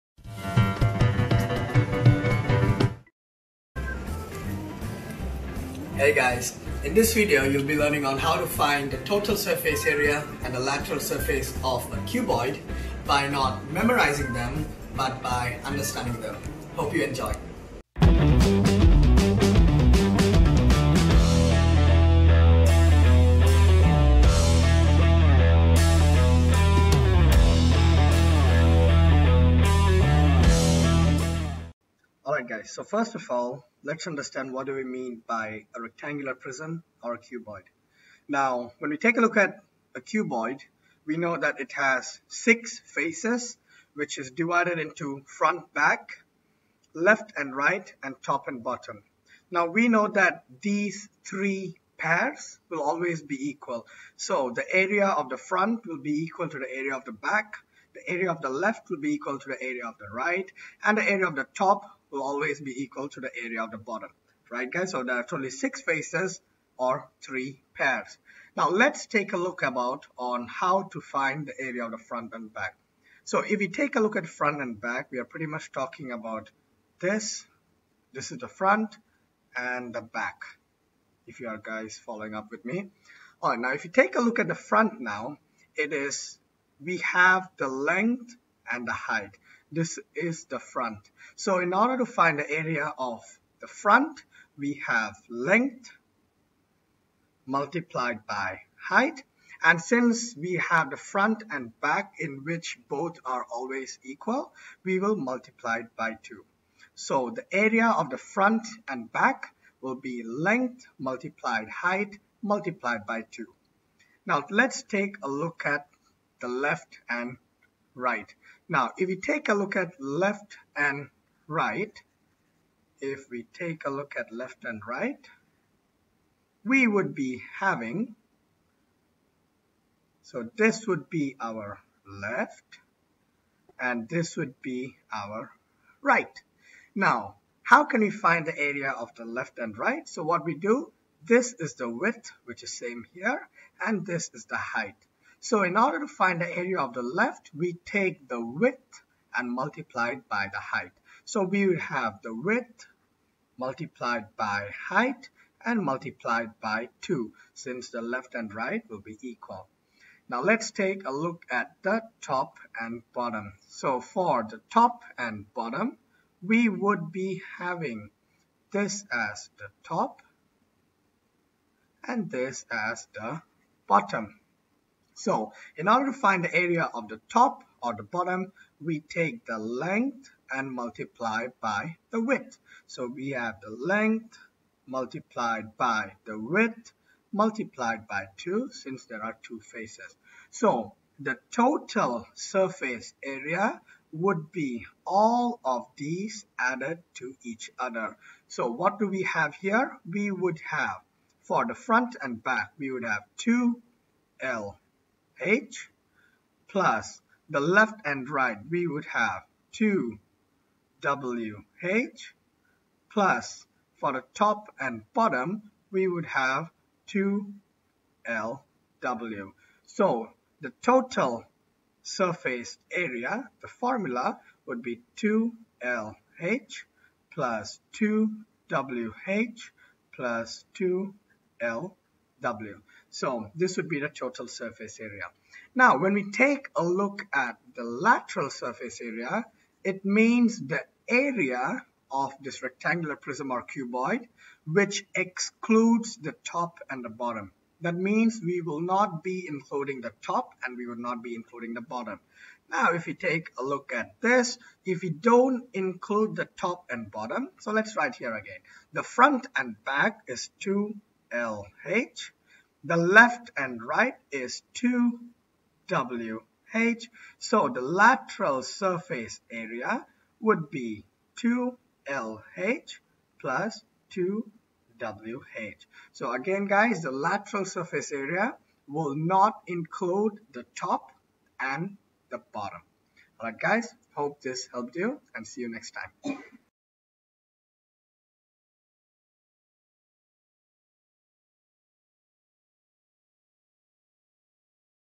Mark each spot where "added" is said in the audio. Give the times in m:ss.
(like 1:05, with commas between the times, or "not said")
3:16.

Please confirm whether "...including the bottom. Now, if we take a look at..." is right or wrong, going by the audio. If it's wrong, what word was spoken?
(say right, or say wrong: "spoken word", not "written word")
right.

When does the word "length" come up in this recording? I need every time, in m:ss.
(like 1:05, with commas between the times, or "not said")
1:27, 1:35, 1:50, 2:59, 3:03.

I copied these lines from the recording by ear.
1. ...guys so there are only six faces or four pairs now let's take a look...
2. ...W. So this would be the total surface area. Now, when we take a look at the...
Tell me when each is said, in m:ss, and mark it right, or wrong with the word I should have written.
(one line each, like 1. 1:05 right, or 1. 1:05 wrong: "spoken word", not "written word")
1. 1:04 wrong: "three", not "four"
2. 3:52 right.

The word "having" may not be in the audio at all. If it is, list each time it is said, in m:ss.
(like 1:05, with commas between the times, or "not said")
2:07, 2:47.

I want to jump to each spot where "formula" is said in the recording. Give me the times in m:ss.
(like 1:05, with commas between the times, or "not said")
3:43.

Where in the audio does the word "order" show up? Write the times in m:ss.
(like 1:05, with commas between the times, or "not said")
1:31, 2:25, 2:55.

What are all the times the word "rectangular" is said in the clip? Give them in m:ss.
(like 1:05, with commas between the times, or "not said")
0:35, 4:02.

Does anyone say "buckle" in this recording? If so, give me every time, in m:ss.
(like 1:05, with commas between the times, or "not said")
not said.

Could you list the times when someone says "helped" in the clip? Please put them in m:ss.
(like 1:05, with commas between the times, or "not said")
4:44.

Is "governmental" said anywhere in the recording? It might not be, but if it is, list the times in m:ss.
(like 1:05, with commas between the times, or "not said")
not said.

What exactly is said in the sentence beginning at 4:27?
So the lateral surface area would be 2LH plus 2WH.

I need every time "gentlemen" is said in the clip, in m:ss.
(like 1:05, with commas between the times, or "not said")
not said.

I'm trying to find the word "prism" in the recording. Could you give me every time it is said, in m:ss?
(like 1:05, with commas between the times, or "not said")
0:36, 4:03.